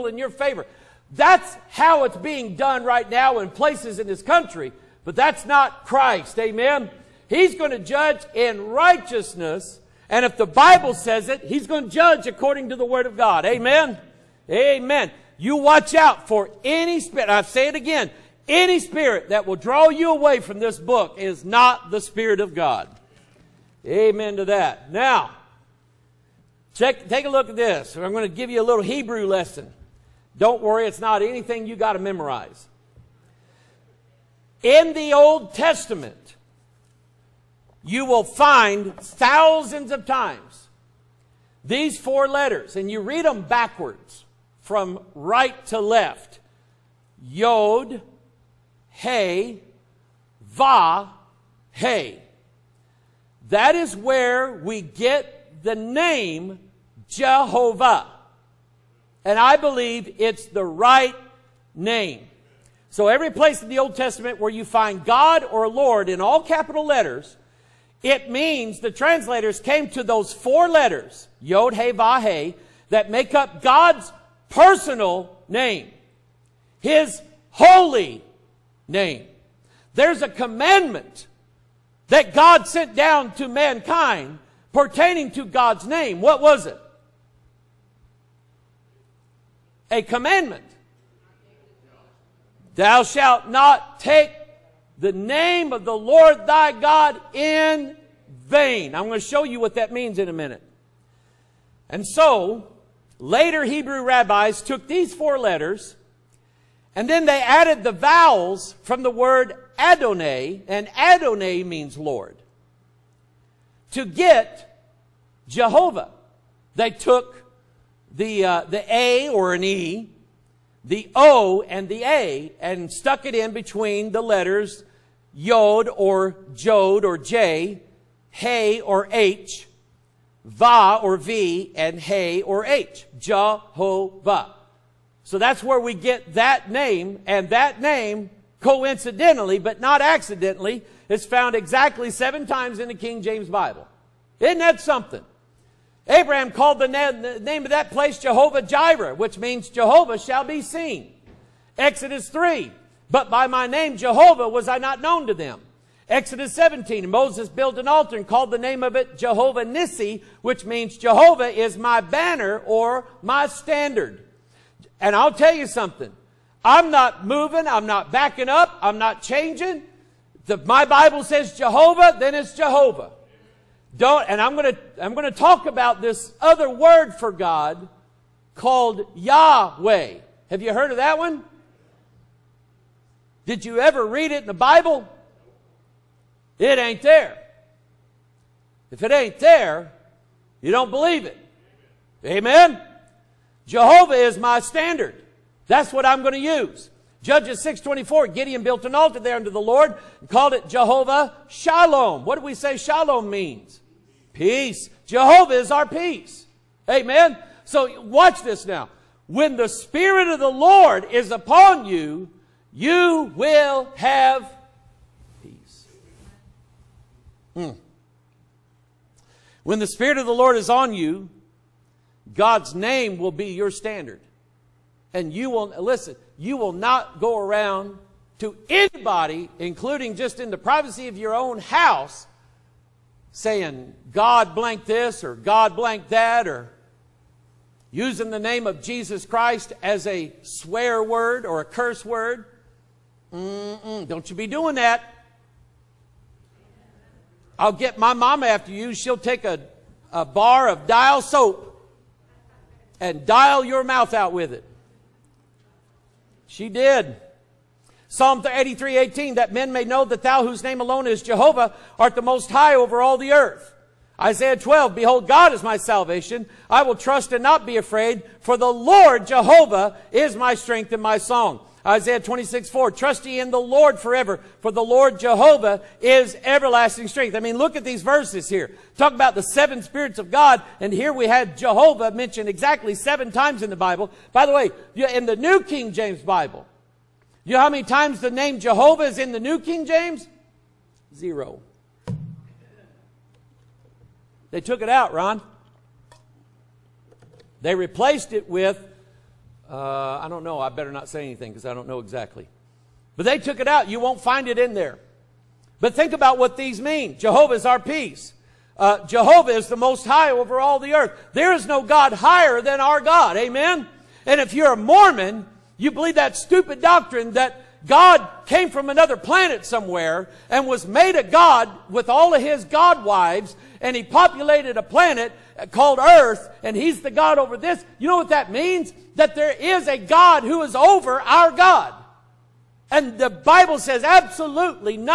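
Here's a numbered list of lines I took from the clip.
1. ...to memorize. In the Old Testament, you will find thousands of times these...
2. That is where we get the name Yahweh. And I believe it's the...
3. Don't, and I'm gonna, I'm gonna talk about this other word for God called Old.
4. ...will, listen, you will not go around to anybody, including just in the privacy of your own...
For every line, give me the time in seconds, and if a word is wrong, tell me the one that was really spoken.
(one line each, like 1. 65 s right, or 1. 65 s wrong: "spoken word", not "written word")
1. 31 s right
2. 53 s wrong: "Jehovah", not "Yahweh"
3. 173 s wrong: "Yahweh", not "Old"
4. 225 s right.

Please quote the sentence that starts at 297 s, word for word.
They replaced it with uh, I don't know.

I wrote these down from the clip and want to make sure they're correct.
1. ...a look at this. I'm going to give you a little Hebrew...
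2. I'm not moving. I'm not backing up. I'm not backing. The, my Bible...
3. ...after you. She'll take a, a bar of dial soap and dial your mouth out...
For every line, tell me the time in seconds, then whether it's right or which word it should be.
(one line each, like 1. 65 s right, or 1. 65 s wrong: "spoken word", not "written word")
1. 27 s right
2. 166 s wrong: "changing", not "backing"
3. 248 s right.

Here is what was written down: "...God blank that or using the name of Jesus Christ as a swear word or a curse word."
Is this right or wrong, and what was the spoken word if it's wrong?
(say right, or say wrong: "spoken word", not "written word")
right.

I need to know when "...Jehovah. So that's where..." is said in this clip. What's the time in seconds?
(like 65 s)
133 s.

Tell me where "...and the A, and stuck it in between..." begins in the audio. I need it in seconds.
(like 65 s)
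121 s.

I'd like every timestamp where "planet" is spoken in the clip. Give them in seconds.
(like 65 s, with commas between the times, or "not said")
319 s, 324 s.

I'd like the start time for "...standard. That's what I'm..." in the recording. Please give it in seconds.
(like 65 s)
194 s.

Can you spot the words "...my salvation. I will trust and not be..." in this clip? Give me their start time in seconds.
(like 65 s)
265 s.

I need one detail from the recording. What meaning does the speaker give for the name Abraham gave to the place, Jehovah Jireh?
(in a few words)
Jehovah shall be seen.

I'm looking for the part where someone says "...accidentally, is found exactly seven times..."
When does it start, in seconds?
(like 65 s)
140 s.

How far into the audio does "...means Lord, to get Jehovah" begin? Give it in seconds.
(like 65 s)
111 s.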